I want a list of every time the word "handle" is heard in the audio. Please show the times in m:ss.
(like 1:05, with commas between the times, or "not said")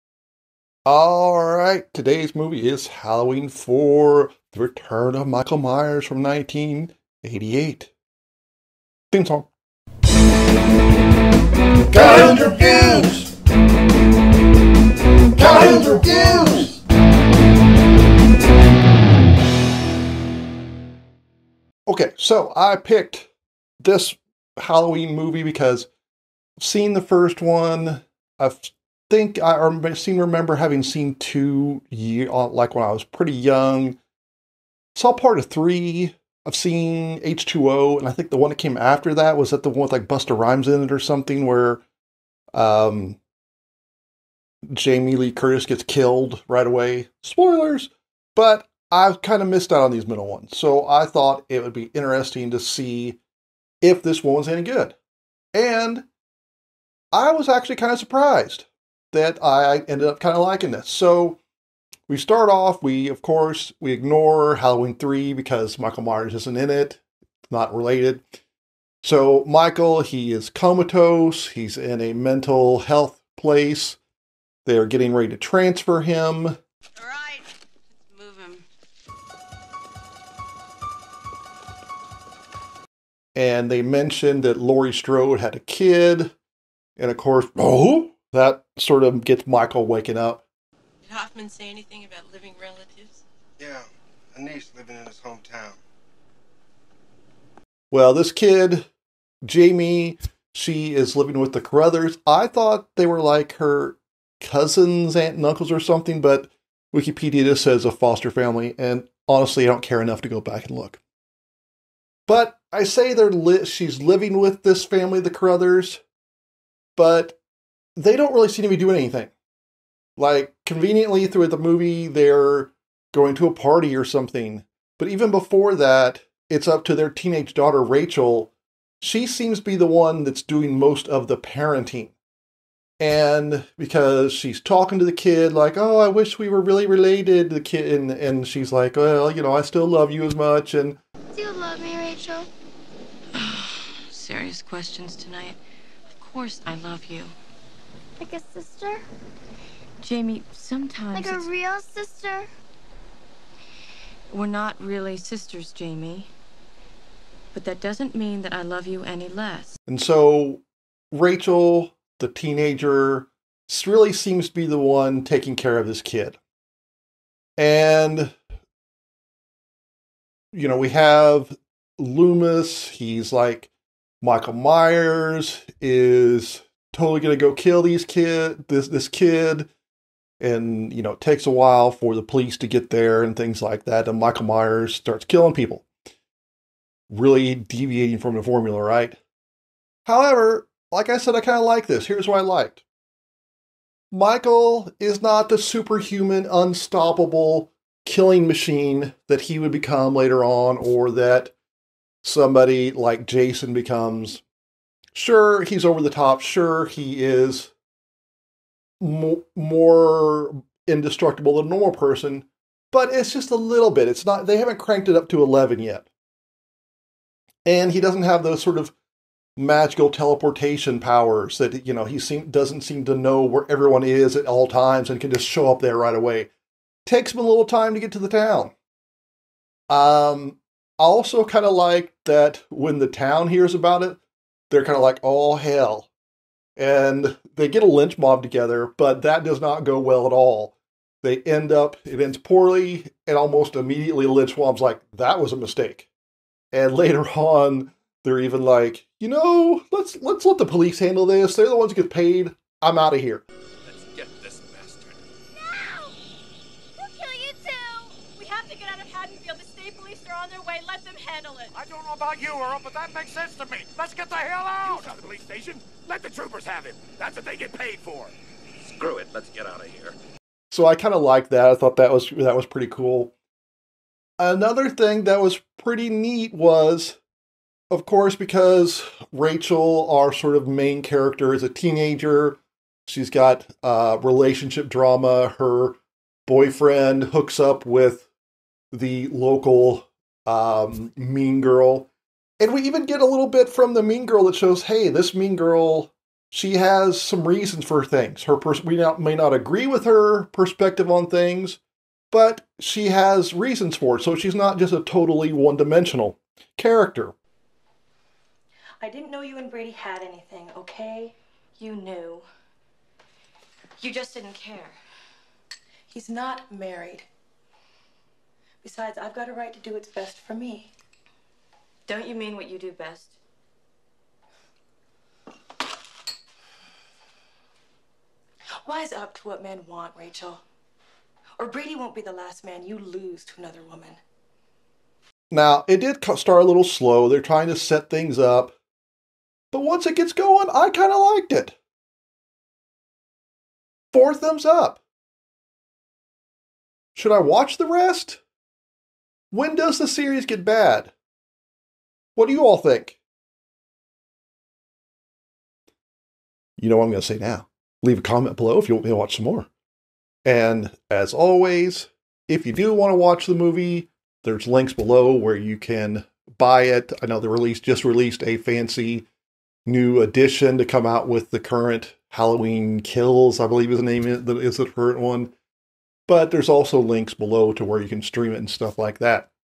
4:10, 4:21.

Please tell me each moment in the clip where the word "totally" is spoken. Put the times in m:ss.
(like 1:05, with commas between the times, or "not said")
2:56, 5:05.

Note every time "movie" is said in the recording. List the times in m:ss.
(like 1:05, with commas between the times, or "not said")
0:02, 0:25, 2:01, 6:03.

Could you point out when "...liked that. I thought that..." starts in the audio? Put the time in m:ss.
4:31.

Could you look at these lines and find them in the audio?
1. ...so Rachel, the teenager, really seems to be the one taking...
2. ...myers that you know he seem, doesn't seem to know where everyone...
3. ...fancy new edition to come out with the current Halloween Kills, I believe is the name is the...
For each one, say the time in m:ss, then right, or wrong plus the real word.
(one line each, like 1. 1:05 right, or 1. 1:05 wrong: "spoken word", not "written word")
1. 2:39 right
2. 3:40 wrong: "powers", not "myers"
3. 6:08 right.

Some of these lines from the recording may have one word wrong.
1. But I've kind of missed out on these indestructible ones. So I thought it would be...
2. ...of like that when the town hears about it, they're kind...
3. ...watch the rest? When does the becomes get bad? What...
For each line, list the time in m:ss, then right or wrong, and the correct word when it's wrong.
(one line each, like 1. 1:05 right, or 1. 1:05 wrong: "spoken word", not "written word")
1. 0:48 wrong: "middle", not "indestructible"
2. 3:51 right
3. 5:47 wrong: "series", not "becomes".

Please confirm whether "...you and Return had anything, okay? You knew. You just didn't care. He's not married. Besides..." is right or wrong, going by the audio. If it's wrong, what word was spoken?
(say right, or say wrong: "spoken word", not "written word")
wrong: "Brady", not "Return".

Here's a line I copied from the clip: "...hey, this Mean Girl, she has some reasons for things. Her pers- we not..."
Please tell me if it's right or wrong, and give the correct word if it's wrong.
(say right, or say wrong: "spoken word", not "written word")
right.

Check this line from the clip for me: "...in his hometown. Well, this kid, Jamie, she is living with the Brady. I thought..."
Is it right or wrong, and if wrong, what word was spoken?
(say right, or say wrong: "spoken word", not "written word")
wrong: "Carruthers", not "Brady".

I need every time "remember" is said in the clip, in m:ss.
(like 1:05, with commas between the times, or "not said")
0:30.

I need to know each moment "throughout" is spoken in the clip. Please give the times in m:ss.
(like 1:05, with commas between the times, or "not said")
2:01.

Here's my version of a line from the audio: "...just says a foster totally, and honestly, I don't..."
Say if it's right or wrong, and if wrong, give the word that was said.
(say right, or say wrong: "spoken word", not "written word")
wrong: "family", not "totally".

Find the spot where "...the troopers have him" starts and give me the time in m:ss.
4:26.